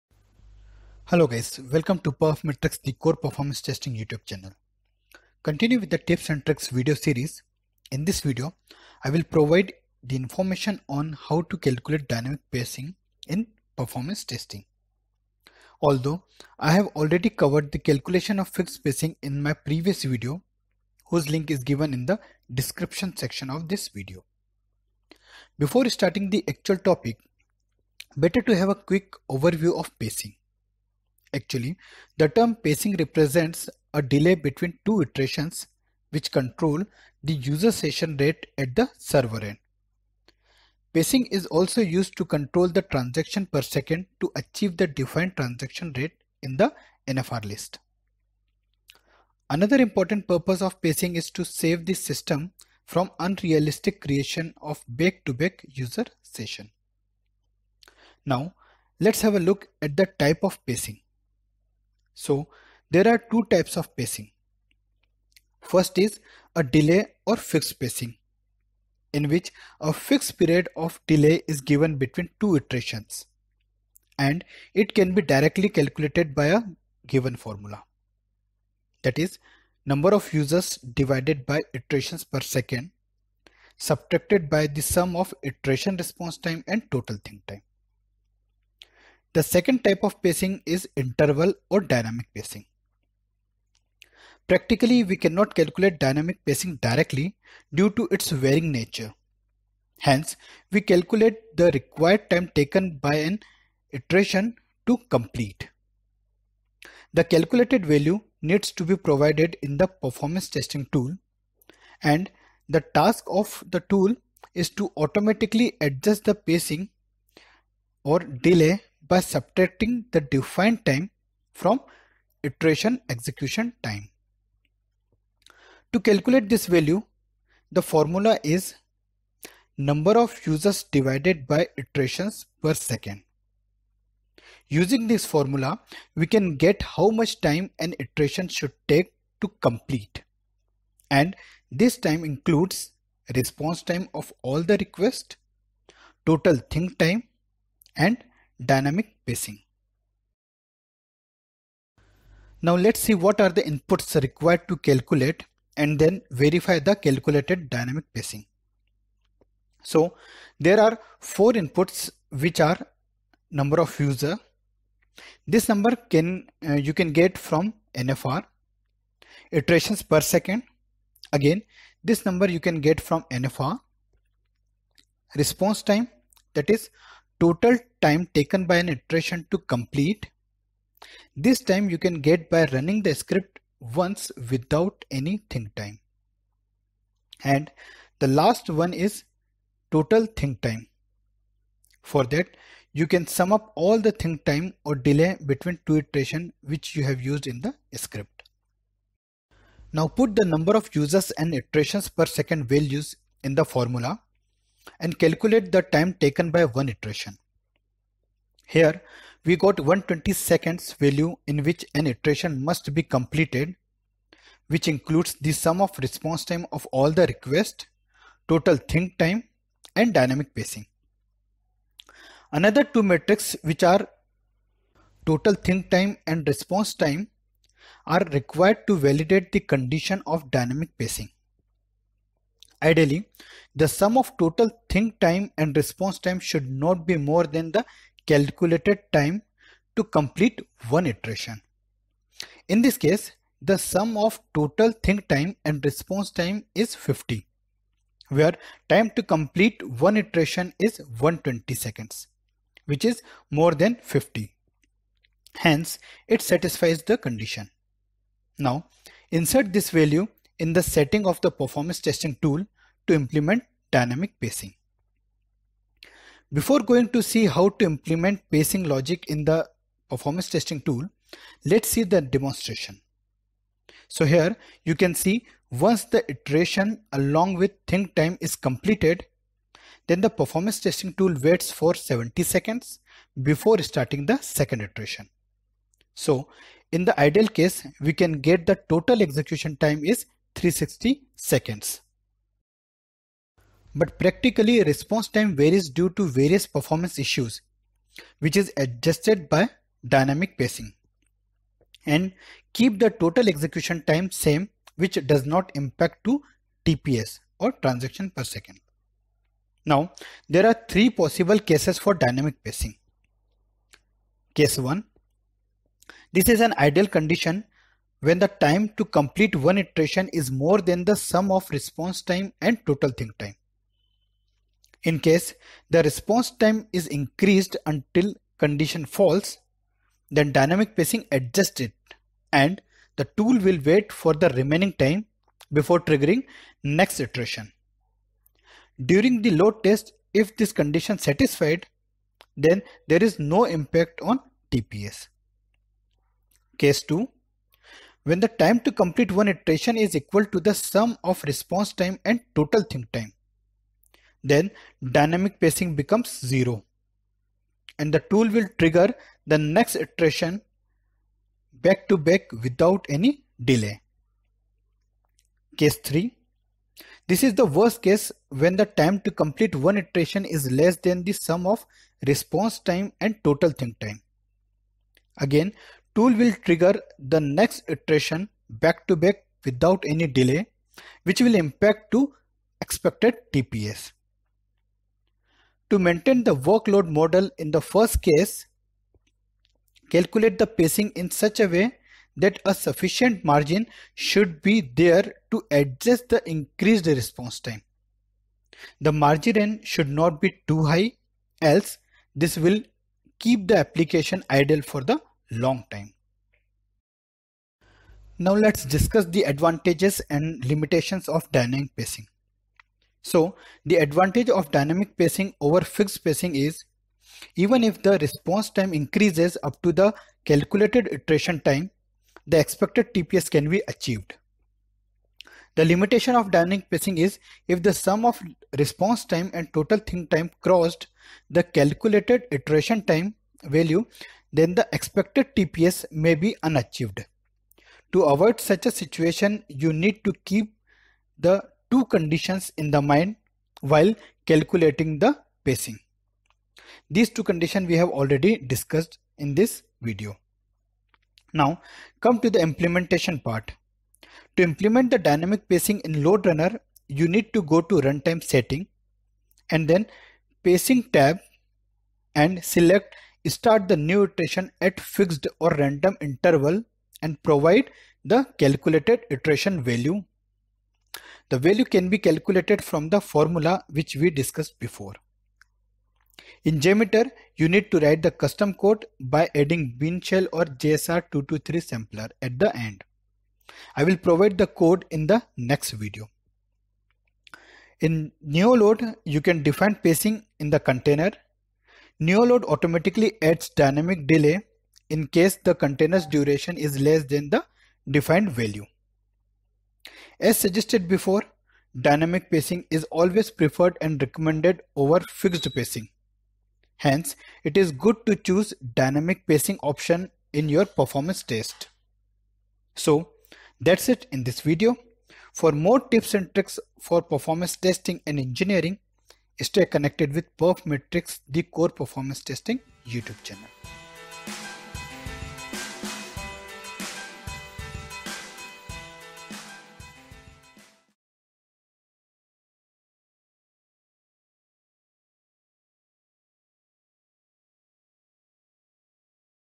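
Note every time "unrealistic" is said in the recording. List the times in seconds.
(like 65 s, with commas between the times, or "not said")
53 s.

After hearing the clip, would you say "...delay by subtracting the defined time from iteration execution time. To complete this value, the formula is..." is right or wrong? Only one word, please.
wrong.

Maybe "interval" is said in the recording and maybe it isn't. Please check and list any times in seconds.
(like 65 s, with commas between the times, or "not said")
90 s, 466 s.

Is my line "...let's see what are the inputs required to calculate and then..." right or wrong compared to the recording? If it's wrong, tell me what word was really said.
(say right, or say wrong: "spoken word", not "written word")
right.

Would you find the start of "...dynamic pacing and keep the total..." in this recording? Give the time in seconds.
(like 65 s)
300 s.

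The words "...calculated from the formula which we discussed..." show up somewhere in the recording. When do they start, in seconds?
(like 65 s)
472 s.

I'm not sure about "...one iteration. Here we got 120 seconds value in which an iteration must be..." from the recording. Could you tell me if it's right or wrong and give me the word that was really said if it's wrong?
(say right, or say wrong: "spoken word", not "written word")
right.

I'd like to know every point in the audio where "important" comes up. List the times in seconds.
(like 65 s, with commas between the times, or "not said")
49 s.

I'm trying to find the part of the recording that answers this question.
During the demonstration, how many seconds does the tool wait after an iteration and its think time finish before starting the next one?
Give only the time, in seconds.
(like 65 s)
281 s.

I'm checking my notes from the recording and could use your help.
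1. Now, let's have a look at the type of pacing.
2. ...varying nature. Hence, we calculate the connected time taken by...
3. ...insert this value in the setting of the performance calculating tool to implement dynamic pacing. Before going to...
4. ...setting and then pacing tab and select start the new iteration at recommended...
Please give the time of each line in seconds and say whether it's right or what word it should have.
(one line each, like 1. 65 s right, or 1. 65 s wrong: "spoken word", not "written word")
1. 58 s right
2. 98 s wrong: "required", not "connected"
3. 259 s wrong: "testing", not "calculating"
4. 458 s wrong: "fixed", not "recommended".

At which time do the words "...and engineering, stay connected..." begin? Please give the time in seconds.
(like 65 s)
518 s.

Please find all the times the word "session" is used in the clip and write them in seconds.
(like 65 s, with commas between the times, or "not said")
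37 s, 56 s.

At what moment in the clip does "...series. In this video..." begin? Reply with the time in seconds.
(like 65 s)
6 s.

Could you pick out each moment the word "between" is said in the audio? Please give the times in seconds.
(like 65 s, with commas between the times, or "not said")
34 s, 71 s, 195 s.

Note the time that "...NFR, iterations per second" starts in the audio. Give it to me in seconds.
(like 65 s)
167 s.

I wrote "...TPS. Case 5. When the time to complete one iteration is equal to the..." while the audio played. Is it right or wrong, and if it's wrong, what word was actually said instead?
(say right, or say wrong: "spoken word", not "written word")
wrong: "2", not "5".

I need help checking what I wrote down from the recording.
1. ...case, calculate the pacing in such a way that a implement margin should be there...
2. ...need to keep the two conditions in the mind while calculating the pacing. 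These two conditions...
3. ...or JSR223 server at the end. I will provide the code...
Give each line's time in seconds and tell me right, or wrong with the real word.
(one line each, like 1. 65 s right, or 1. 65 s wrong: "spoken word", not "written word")
1. 388 s wrong: "sufficient", not "implement"
2. 439 s right
3. 480 s wrong: "sampler", not "server".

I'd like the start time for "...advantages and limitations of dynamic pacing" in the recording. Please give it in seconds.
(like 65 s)
409 s.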